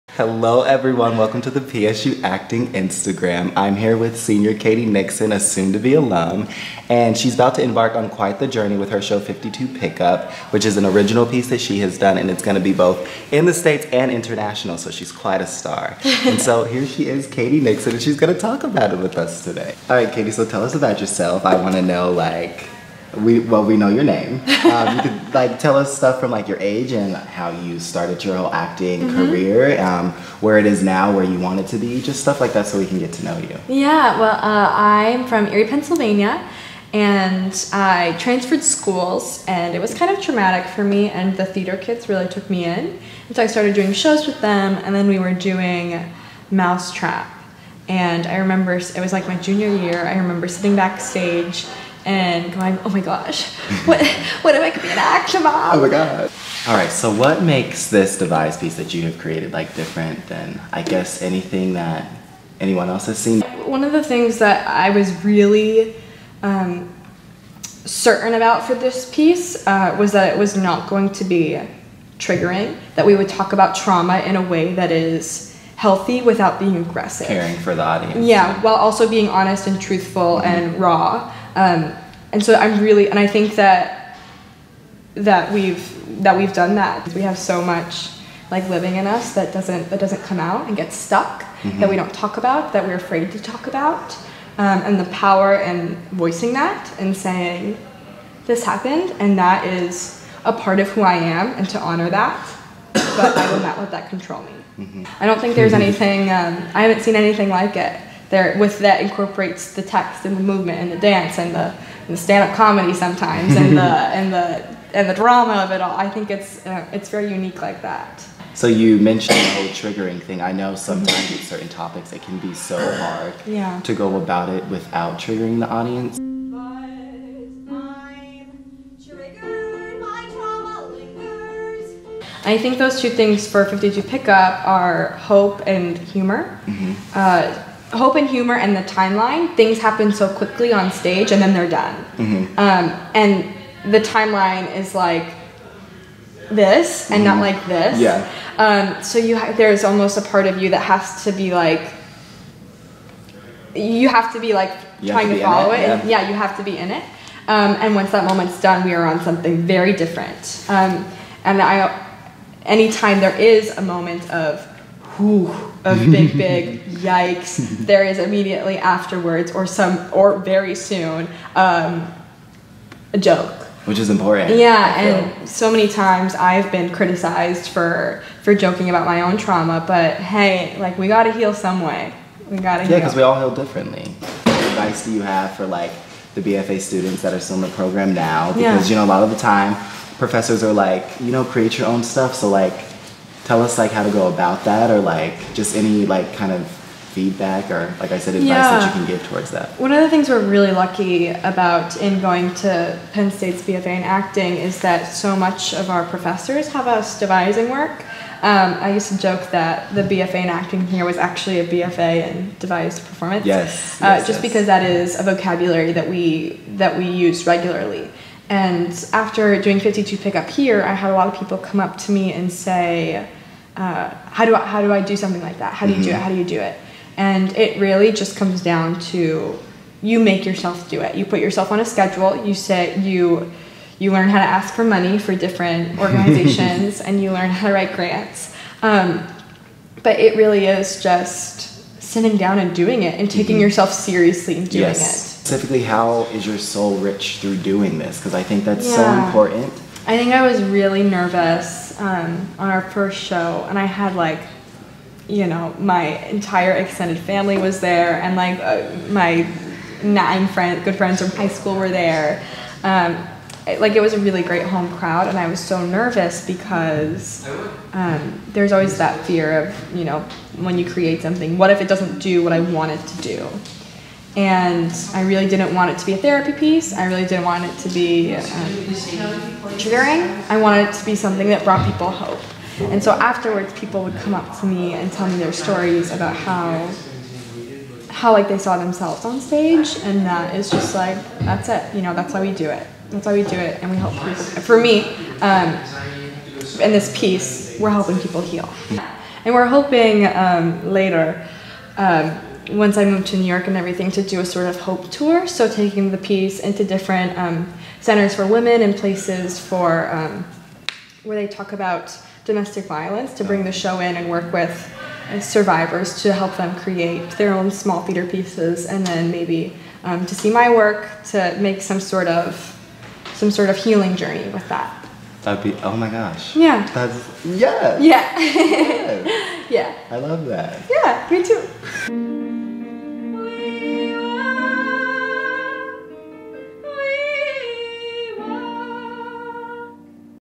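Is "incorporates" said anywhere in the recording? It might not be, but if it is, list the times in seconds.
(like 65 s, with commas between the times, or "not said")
109 s.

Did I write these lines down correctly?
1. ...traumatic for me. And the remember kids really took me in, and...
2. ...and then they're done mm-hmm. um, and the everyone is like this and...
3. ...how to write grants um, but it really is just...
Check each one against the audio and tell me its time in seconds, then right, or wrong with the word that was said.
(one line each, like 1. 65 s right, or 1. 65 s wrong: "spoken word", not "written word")
1. 40 s wrong: "theater", not "remember"
2. 141 s wrong: "timeline", not "everyone"
3. 237 s right.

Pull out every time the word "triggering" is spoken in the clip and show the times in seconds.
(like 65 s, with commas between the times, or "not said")
72 s, 119 s, 125 s, 279 s.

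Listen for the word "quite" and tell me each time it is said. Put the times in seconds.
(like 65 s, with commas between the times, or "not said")
8 s, 15 s.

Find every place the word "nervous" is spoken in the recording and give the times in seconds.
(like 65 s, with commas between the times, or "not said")
251 s, 265 s.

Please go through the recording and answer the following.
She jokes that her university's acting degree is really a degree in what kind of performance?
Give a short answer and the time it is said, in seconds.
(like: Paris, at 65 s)
devised performance, at 212 s.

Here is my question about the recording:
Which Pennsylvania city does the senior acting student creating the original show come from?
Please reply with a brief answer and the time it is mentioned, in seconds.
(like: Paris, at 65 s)
Erie, at 35 s.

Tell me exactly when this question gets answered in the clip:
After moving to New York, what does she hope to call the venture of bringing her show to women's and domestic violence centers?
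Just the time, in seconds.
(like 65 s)
304 s.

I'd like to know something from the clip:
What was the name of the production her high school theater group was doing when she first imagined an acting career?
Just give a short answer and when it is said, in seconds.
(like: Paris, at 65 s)
Mousetrap, at 46 s.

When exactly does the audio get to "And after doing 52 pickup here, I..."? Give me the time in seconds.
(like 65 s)
218 s.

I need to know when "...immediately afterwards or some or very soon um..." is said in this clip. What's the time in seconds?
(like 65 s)
168 s.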